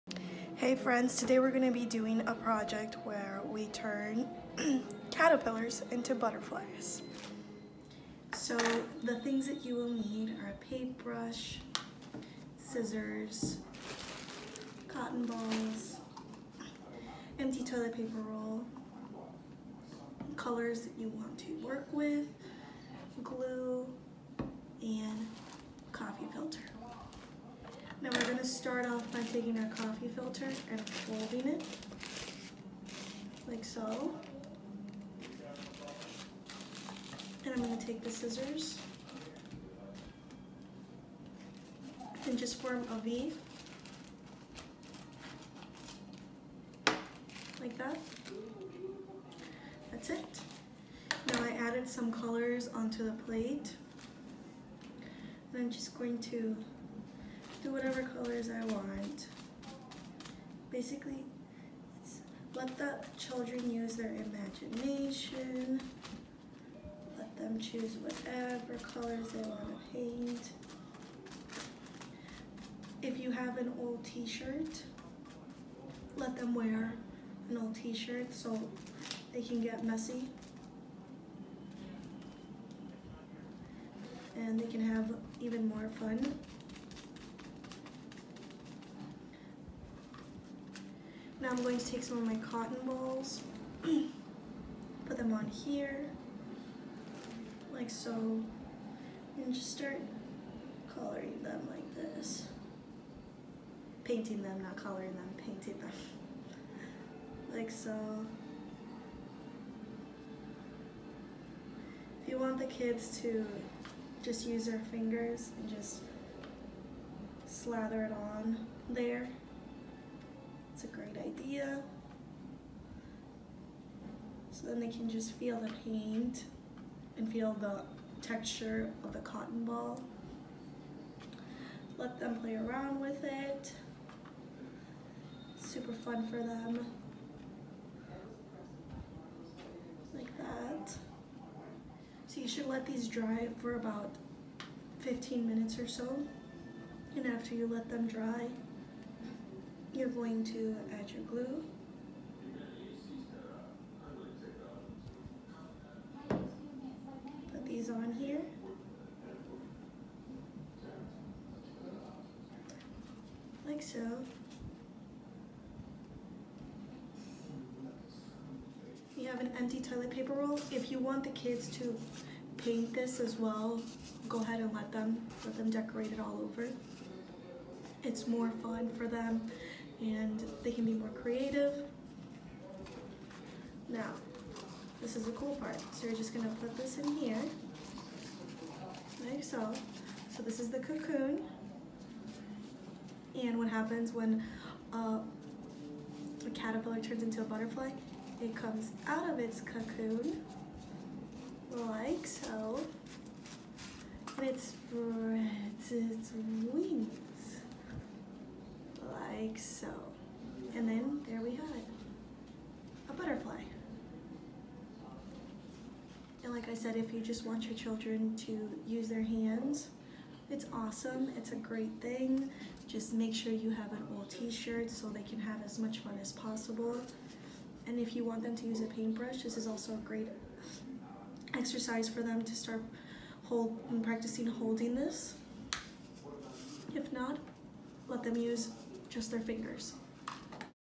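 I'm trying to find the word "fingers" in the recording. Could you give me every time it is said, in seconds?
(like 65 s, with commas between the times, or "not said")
114 s, 239 s.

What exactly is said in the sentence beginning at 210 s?
And then there we have it, a butterfly.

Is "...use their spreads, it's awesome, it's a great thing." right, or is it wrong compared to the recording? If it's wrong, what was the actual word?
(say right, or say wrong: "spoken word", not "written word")
wrong: "hands", not "spreads".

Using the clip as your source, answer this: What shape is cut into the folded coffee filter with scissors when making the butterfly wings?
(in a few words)
V.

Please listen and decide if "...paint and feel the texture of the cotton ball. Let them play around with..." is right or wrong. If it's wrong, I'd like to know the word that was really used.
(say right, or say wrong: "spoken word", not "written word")
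right.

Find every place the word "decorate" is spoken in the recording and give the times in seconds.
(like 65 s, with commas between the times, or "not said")
175 s.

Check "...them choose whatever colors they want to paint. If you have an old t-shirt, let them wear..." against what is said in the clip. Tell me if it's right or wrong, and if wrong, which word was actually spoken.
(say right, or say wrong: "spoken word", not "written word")
right.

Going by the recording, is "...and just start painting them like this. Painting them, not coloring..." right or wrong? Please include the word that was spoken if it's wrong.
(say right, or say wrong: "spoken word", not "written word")
wrong: "coloring", not "painting".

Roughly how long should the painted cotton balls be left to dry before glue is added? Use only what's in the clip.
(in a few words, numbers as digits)
15 minutes.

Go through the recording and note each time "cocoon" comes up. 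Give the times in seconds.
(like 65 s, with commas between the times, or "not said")
190 s, 199 s.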